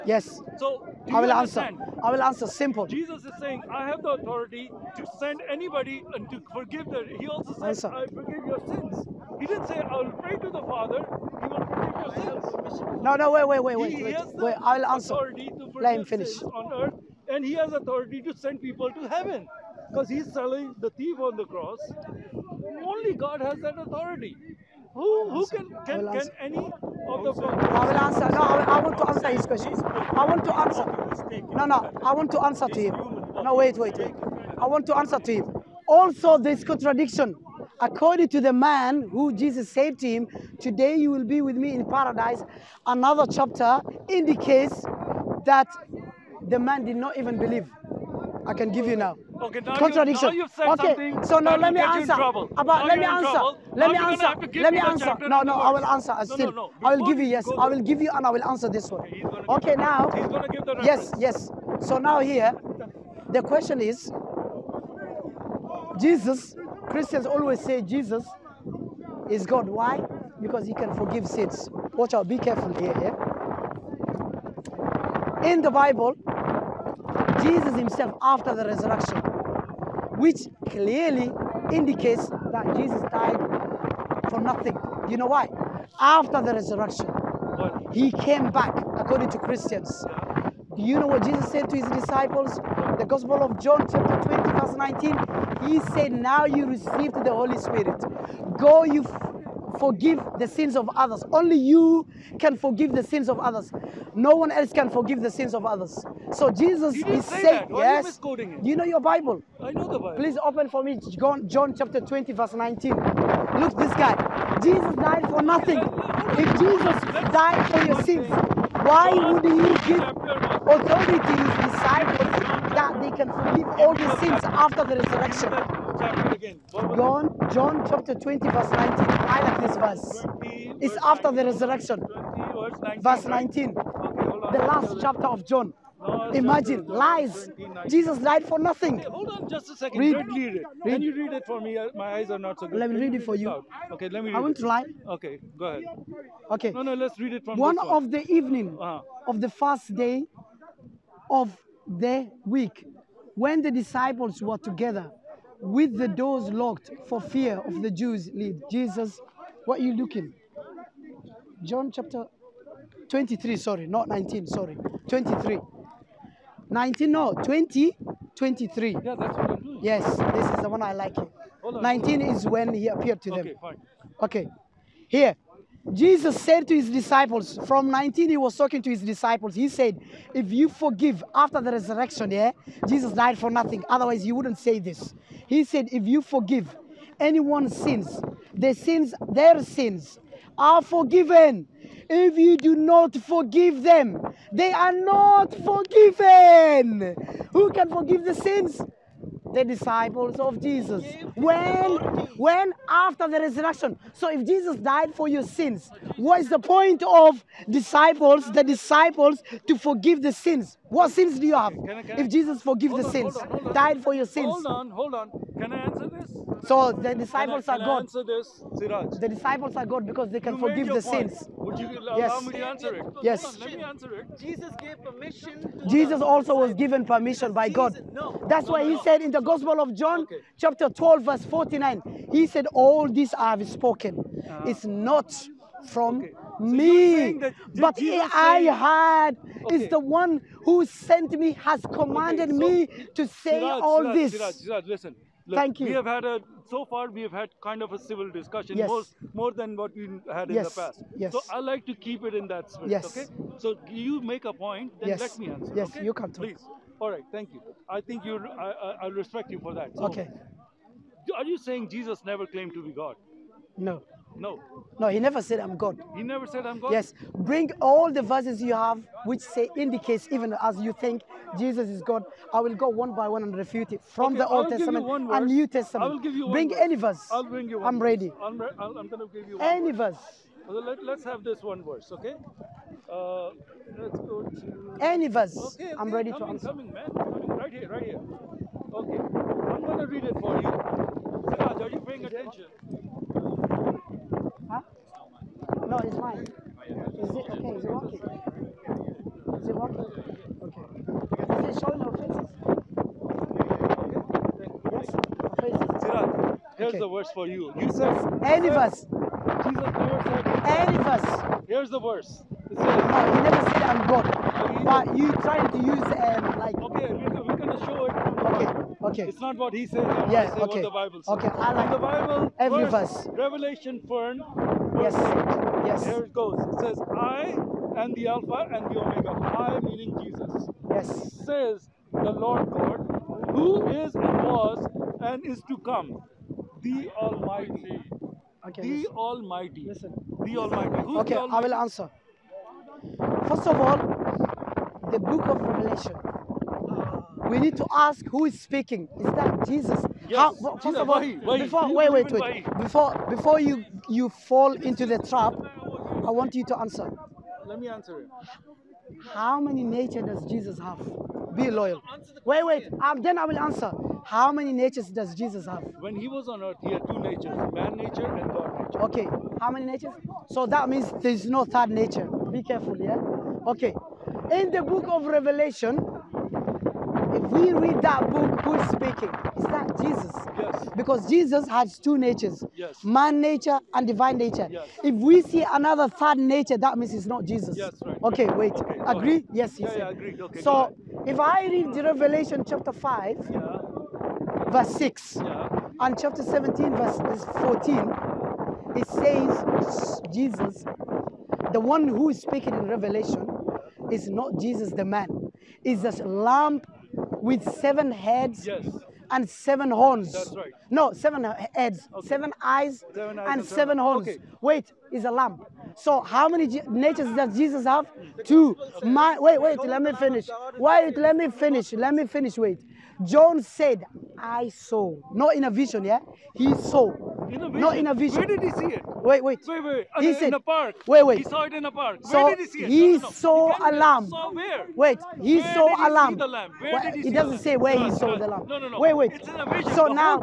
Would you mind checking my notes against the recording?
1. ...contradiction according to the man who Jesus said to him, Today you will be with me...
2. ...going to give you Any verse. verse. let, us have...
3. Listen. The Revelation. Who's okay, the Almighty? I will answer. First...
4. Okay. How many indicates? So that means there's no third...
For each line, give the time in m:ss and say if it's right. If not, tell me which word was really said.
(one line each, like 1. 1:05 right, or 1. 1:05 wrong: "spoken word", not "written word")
1. 0:36 right
2. 4:39 right
3. 5:39 wrong: "Almighty", not "Revelation"
4. 6:09 wrong: "natures", not "indicates".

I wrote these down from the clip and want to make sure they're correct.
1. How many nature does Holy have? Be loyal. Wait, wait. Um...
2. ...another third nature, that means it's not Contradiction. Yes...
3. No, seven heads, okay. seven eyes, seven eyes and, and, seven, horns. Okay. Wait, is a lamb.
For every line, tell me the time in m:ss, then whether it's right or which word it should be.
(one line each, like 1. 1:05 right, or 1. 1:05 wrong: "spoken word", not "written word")
1. 5:59 wrong: "Jesus", not "Holy"
2. 6:25 wrong: "Jesus", not "Contradiction"
3. 6:50 right.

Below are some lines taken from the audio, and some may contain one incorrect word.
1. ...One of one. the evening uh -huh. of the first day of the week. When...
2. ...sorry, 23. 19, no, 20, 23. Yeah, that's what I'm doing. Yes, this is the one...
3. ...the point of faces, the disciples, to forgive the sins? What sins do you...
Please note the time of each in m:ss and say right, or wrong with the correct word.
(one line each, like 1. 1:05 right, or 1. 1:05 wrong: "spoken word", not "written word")
1. 2:27 right
2. 2:44 right
3. 3:26 wrong: "disciples", not "faces".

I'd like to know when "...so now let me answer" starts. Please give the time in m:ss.
0:51.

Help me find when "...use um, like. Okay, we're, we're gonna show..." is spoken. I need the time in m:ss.
5:15.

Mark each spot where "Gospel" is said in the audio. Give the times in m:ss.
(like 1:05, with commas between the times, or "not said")
1:33, 3:49.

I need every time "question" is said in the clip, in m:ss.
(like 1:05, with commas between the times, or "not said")
0:29, 1:03.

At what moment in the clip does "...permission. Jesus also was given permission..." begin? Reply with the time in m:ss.
3:45.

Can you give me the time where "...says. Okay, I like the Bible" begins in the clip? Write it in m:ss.
5:21.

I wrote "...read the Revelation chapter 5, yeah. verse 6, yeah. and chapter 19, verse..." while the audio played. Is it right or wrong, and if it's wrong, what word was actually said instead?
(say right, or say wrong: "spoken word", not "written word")
wrong: "17", not "19".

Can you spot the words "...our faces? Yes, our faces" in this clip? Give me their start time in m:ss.
5:02.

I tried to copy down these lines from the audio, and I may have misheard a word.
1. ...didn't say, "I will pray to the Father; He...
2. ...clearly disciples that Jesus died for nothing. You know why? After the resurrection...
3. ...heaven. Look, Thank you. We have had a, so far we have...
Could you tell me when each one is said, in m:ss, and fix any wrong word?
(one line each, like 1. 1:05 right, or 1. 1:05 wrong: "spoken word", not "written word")
1. 0:09 right
2. 1:20 wrong: "indicates", not "disciples"
3. 4:04 wrong: "listen", not "heaven".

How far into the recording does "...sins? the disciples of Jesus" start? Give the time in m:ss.
3:18.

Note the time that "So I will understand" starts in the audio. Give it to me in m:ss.
0:00.